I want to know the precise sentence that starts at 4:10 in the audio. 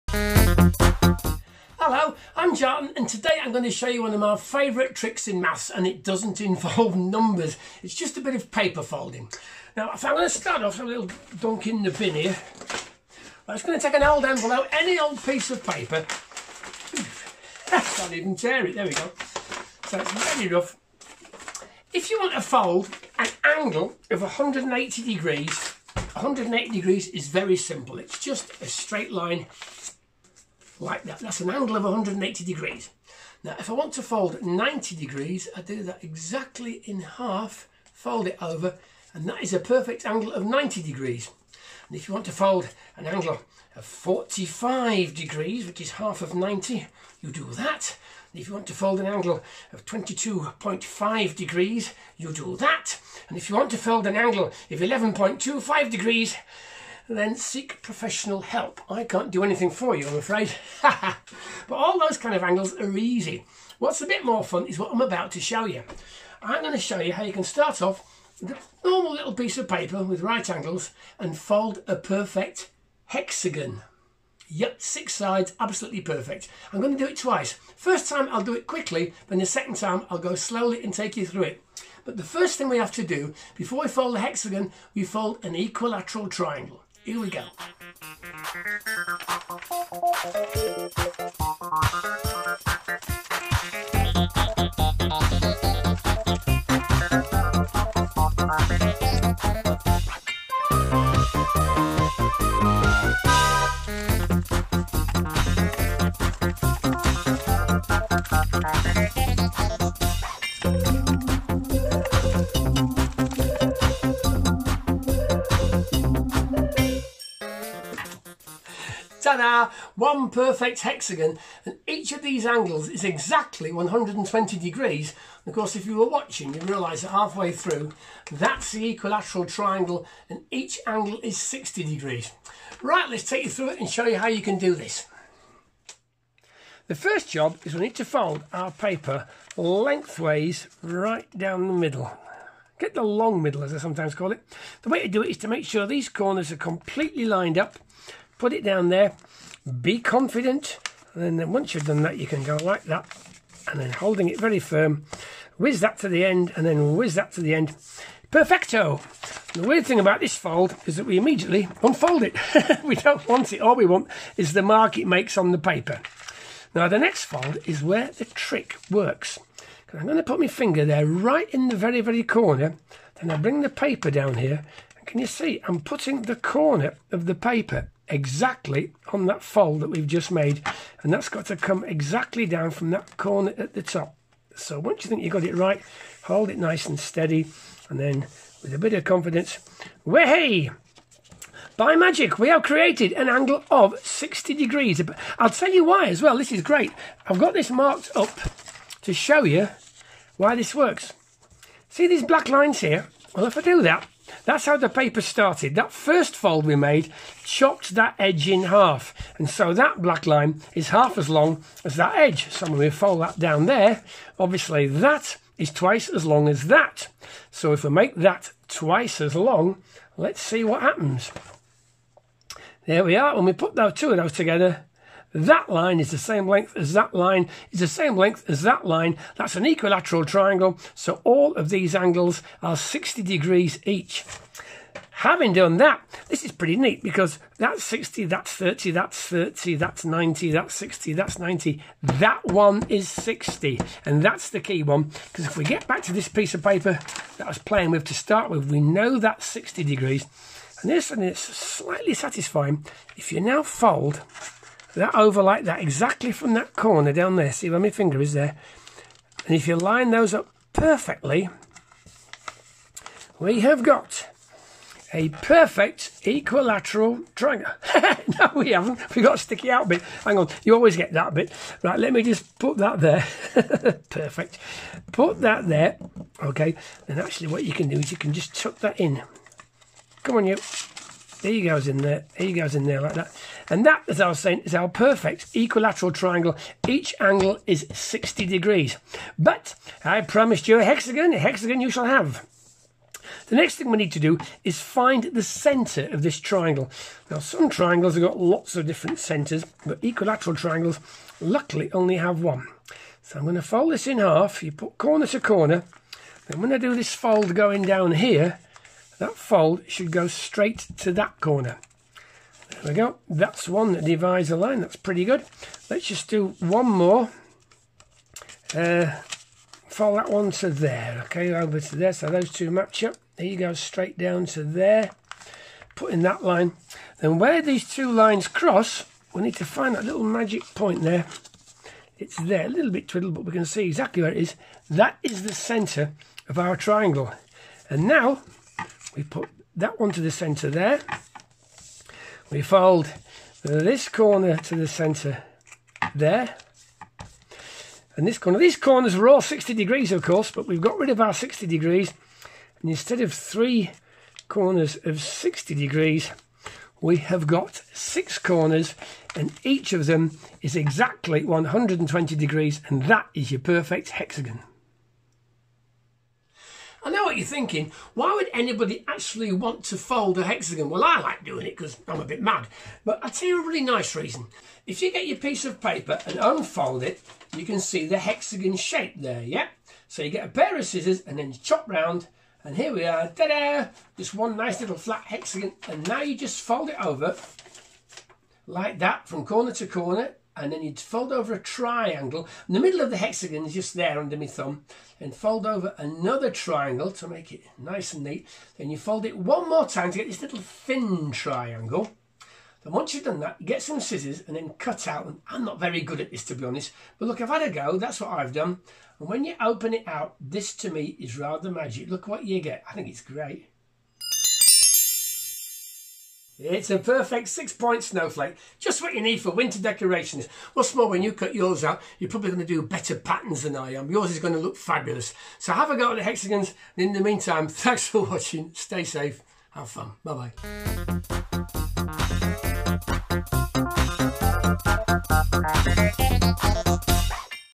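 And this, and it's slightly satisfying.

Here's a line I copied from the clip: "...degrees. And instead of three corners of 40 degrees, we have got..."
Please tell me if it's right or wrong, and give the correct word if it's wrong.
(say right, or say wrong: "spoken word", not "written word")
wrong: "60", not "40".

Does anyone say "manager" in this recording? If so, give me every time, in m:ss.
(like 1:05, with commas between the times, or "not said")
not said.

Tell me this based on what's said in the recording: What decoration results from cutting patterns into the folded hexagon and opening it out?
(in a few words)
six-point snowflake.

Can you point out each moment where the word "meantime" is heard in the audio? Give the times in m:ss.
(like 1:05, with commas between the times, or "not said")
7:07.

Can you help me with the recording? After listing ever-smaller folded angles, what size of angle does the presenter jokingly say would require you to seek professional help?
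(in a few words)
11.25 degrees.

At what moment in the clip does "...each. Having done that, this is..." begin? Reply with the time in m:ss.
3:53.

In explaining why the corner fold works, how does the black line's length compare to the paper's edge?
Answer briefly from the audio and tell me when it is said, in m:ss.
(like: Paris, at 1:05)
half as long, at 3:30.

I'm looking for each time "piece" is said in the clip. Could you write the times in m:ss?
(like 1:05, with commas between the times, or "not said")
0:15, 1:09, 4:06, 6:15.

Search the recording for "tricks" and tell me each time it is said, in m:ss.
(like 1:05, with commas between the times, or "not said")
0:04, 2:48.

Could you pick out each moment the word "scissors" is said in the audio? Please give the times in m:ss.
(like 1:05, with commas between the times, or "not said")
6:20, 6:43.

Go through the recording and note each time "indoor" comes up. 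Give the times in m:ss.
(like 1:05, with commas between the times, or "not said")
not said.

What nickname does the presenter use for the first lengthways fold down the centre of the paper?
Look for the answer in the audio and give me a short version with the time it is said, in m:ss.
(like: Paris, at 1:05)
the long middle, at 2:22.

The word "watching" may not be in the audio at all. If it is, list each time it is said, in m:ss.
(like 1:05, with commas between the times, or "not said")
2:06, 7:08.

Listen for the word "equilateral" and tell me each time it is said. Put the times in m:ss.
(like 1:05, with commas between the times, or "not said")
1:25, 2:08, 3:49, 4:26, 4:45, 5:00.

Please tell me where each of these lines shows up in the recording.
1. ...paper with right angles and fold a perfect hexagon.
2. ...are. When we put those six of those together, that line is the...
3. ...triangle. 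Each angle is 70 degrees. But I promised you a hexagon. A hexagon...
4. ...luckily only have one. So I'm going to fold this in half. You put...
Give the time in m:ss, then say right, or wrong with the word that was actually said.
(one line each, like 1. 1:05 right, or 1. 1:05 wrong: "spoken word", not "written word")
1. 1:09 right
2. 3:43 wrong: "two", not "six"
3. 4:46 wrong: "60", not "70"
4. 5:01 right.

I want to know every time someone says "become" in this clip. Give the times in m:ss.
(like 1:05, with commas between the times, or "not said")
not said.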